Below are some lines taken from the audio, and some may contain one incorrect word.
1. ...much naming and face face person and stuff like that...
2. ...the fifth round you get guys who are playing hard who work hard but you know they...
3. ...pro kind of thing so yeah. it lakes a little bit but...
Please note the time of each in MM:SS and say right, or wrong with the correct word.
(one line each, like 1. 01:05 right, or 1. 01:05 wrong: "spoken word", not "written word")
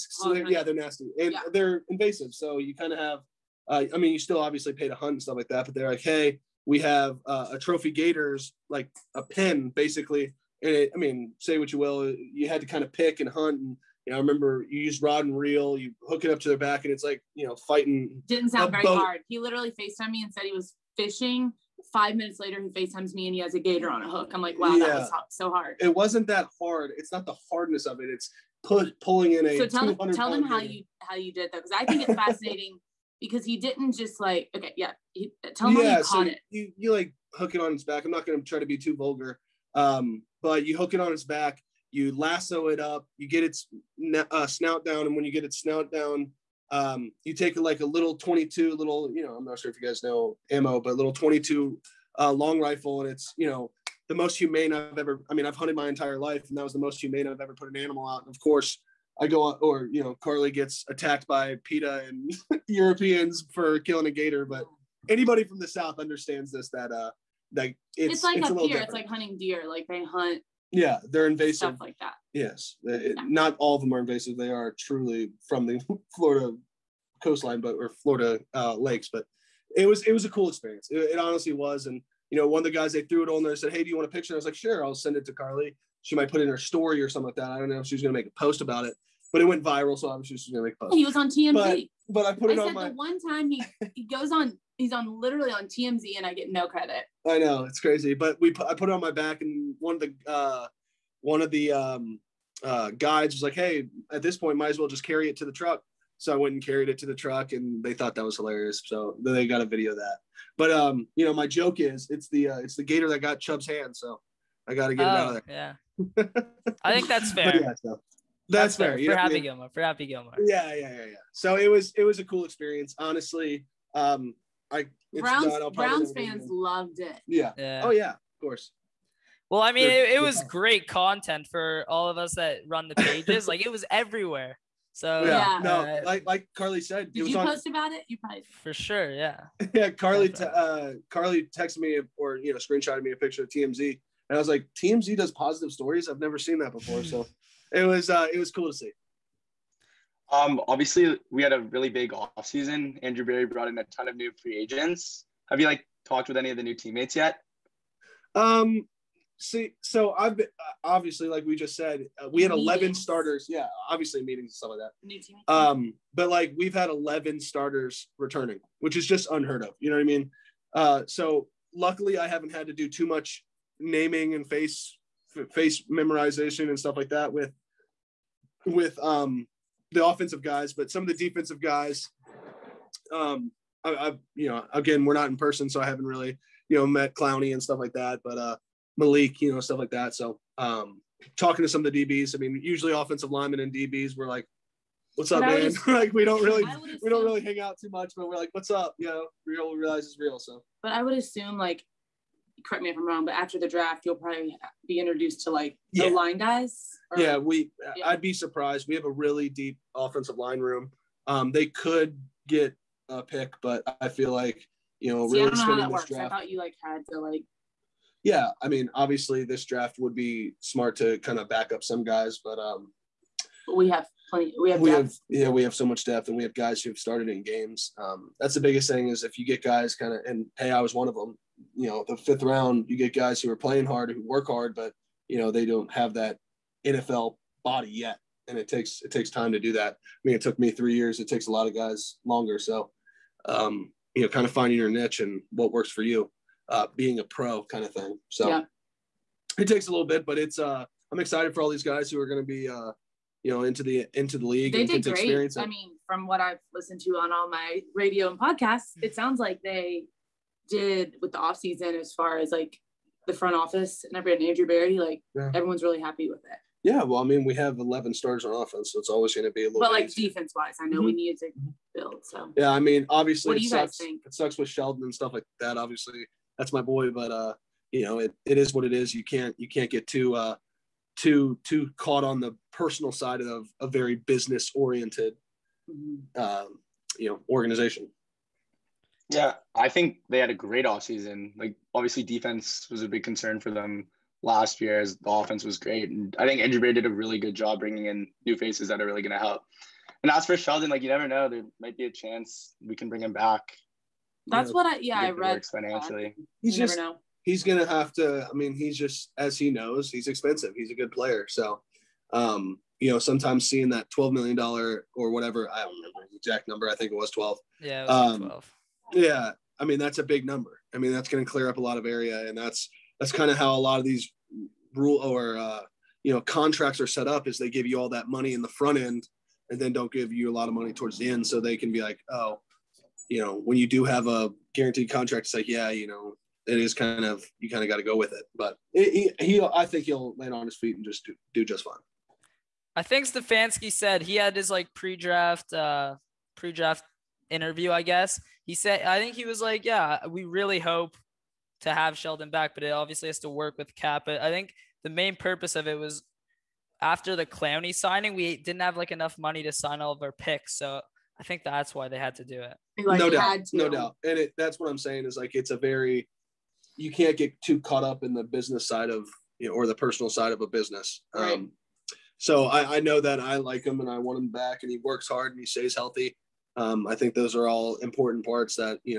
1. 02:53 wrong: "memorization", not "person"
2. 03:52 right
3. 04:07 wrong: "takes", not "lakes".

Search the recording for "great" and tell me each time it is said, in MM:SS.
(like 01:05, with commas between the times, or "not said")
02:10, 04:15, 04:50, 04:55.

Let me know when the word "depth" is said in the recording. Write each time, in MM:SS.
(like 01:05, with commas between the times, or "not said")
03:46.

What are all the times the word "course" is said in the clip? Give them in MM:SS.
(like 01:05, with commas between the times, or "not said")
00:58, 02:08.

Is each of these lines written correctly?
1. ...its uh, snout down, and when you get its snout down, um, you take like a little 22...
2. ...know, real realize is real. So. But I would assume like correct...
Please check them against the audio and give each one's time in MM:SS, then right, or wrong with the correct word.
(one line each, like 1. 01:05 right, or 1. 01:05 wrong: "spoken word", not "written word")
1. 00:43 right
2. 03:19 right.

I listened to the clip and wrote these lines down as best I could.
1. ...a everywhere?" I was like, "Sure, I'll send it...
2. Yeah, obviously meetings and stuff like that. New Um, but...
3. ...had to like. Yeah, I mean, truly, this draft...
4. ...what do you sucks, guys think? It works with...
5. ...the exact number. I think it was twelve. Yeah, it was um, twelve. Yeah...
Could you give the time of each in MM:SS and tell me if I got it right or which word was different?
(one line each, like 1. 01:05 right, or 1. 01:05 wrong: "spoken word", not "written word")
1. 01:24 wrong: "picture", not "everywhere"
2. 02:43 right
3. 03:36 wrong: "obviously", not "truly"
4. 04:33 wrong: "sucks", not "works"
5. 05:16 right.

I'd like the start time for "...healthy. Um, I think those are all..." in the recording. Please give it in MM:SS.
06:15.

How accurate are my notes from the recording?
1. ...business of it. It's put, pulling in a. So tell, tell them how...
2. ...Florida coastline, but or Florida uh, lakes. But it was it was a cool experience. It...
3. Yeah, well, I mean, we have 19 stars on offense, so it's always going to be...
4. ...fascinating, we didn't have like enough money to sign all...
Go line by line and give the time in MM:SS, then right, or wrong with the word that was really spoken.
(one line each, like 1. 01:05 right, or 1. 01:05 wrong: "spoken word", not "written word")
1. 00:27 wrong: "hardness", not "business"
2. 01:16 right
3. 04:26 wrong: "11", not "19"
4. 05:57 wrong: "signing", not "fascinating".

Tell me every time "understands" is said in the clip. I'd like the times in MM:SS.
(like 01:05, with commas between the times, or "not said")
01:05.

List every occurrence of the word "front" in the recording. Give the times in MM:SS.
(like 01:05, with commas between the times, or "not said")
04:23, 05:28.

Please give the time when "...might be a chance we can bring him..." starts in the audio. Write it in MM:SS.
05:01.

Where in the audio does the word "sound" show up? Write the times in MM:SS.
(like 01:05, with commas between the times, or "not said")
00:18, 04:19.